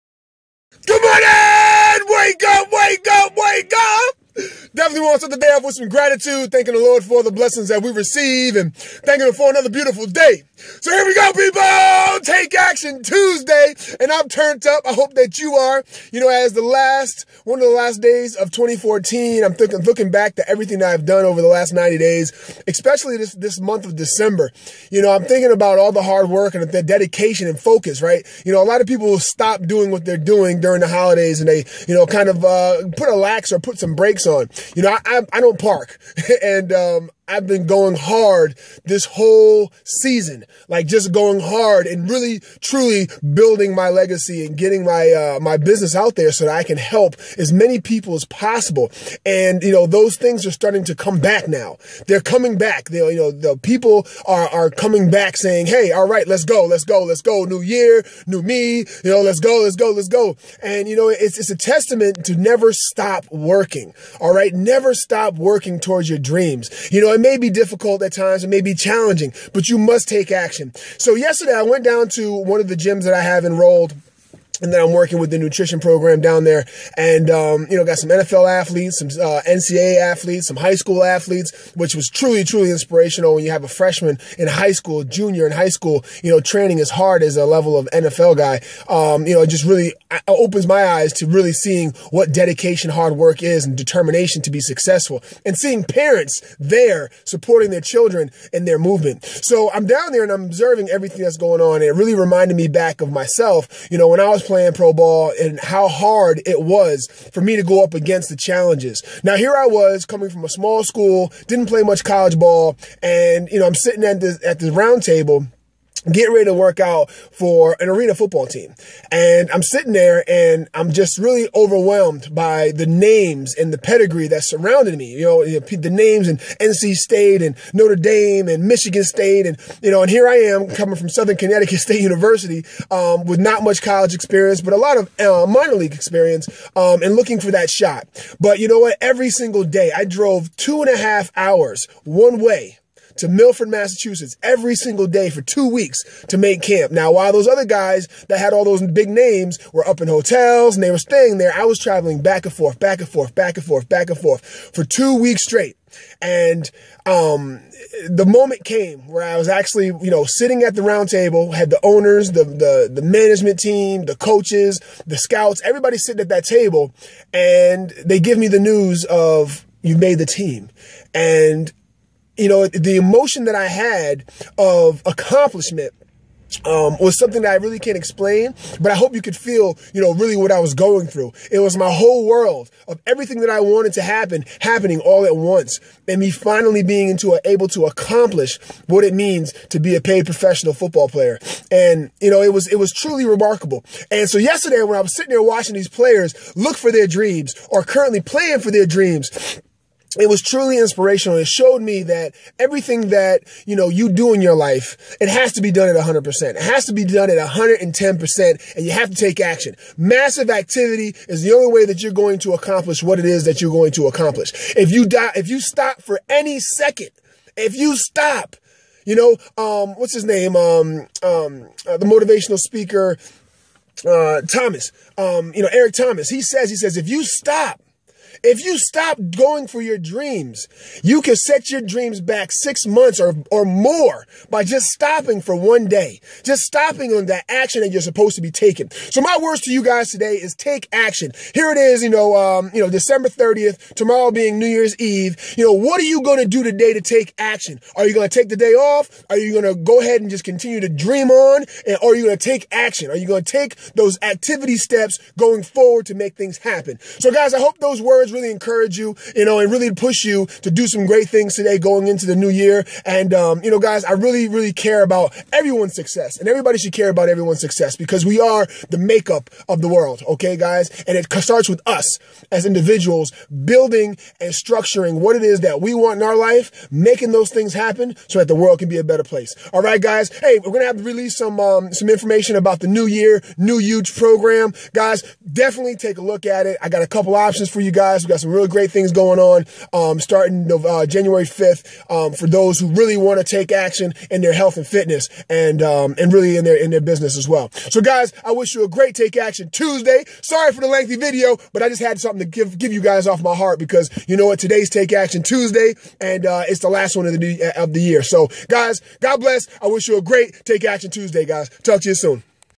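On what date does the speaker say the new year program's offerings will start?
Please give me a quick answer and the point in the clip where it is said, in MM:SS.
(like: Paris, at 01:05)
January 5th, at 04:51.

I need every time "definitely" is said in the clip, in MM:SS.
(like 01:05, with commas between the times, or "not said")
00:04, 04:45.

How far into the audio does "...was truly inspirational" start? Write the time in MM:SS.
03:20.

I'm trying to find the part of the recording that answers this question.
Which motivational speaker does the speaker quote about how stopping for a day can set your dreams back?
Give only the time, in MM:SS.
03:45.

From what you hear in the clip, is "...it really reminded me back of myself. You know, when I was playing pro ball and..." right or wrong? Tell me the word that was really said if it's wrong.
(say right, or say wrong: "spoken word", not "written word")
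right.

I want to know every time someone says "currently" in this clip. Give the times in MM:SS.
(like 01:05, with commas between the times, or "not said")
03:17.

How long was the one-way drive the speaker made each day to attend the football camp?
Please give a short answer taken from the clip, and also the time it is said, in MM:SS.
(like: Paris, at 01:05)
two and a half hours, at 02:20.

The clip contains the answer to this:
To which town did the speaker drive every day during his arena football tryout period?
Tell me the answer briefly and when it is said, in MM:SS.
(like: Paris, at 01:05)
Milford, Massachusetts, at 02:23.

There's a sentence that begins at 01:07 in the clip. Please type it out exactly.
I it may be difficult at times.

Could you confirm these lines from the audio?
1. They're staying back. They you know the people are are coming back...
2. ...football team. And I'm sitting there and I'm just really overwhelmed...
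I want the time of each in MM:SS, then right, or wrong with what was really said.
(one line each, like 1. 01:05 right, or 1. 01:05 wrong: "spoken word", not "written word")
1. 00:52 wrong: "coming", not "staying"
2. 01:58 right.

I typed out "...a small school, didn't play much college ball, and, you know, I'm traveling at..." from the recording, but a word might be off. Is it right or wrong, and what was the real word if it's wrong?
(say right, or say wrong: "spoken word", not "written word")
wrong: "sitting", not "traveling".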